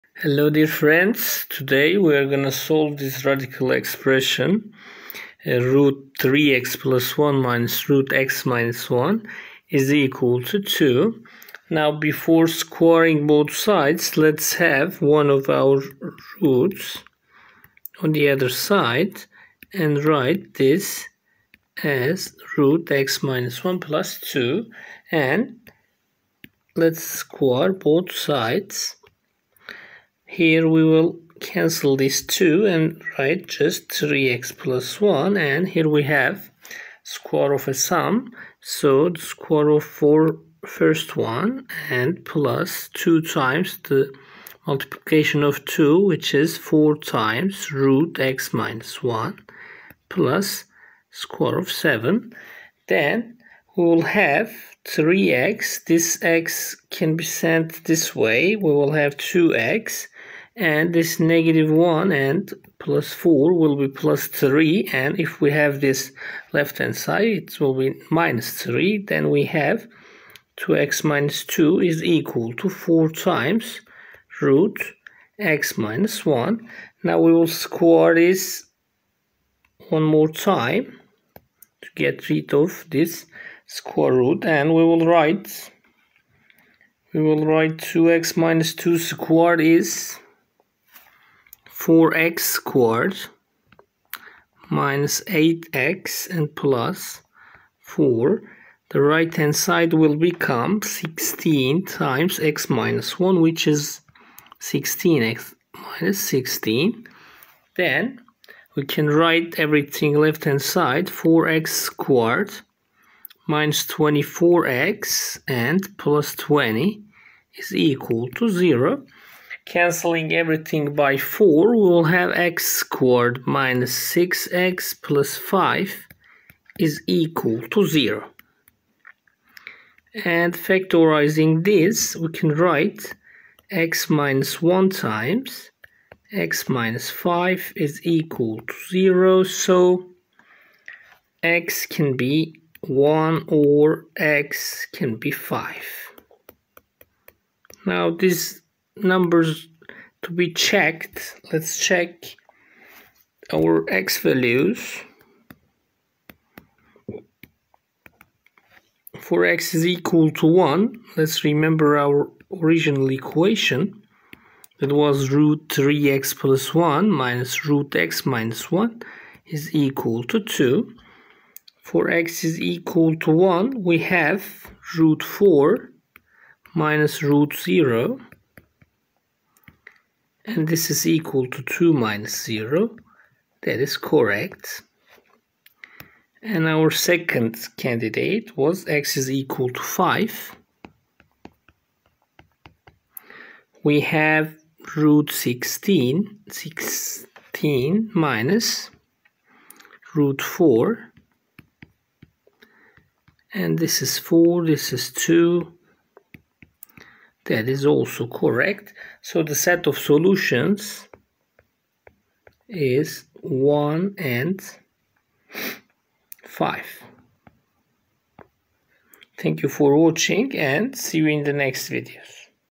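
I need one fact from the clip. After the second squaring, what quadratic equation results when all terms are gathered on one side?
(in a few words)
4x² - 24x + 20 = 0.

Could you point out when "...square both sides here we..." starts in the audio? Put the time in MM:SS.
00:27.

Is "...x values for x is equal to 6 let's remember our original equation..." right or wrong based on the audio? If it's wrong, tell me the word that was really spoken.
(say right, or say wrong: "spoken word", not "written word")
wrong: "1", not "6".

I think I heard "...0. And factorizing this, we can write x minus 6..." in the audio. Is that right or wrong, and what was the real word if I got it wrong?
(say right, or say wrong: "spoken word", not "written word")
wrong: "1", not "6".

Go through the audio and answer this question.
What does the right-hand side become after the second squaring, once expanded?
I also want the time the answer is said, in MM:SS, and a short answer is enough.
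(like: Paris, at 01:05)
16x - 16, at 01:44.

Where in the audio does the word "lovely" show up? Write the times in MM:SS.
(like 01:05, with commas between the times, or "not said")
not said.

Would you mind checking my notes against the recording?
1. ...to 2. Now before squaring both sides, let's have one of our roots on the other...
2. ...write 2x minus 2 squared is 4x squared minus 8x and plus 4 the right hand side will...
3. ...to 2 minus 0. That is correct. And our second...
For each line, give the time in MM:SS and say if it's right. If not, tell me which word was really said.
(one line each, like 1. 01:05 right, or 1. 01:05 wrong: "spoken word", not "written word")
1. 00:10 right
2. 01:27 right
3. 03:01 right.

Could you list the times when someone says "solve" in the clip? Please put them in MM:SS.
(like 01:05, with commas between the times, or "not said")
00:02.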